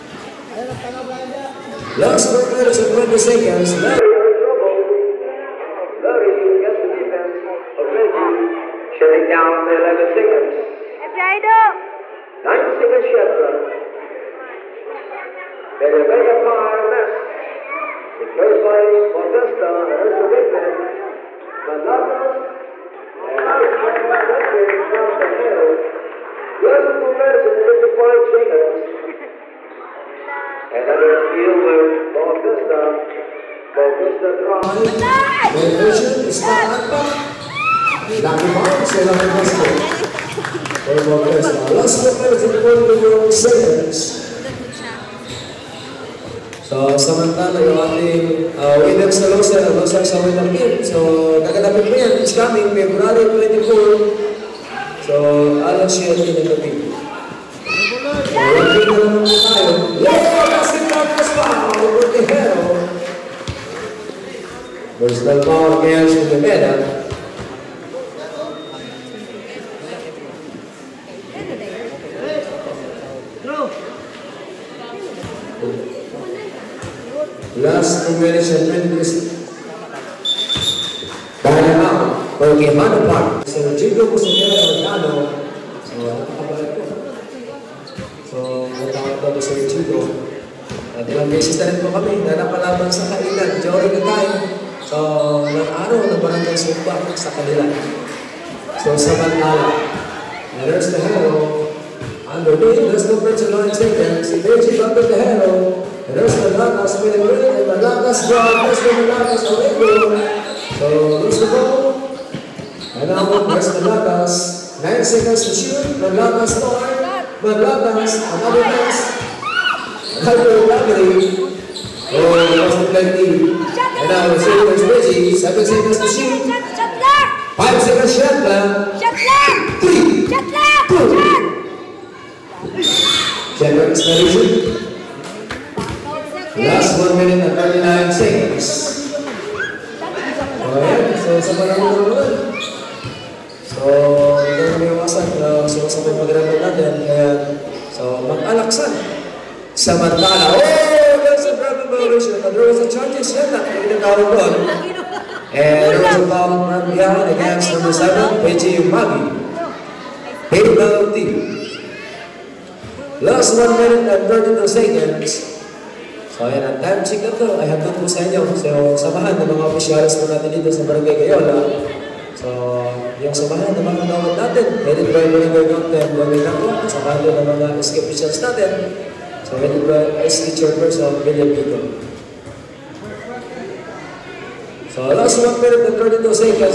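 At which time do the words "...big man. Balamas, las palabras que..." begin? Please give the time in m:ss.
0:20.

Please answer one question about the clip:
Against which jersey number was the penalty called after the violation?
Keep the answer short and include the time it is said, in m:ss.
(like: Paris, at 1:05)
7, at 2:37.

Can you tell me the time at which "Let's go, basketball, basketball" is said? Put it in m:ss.
0:59.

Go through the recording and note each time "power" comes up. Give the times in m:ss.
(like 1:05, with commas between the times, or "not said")
0:16, 1:05.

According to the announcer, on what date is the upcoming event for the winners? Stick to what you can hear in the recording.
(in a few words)
February 24.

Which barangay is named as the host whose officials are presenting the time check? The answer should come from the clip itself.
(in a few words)
Barangay Gayola.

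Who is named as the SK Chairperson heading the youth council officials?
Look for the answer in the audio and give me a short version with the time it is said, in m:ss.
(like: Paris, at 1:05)
William Vito, at 3:01.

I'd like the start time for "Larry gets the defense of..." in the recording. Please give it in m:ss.
0:05.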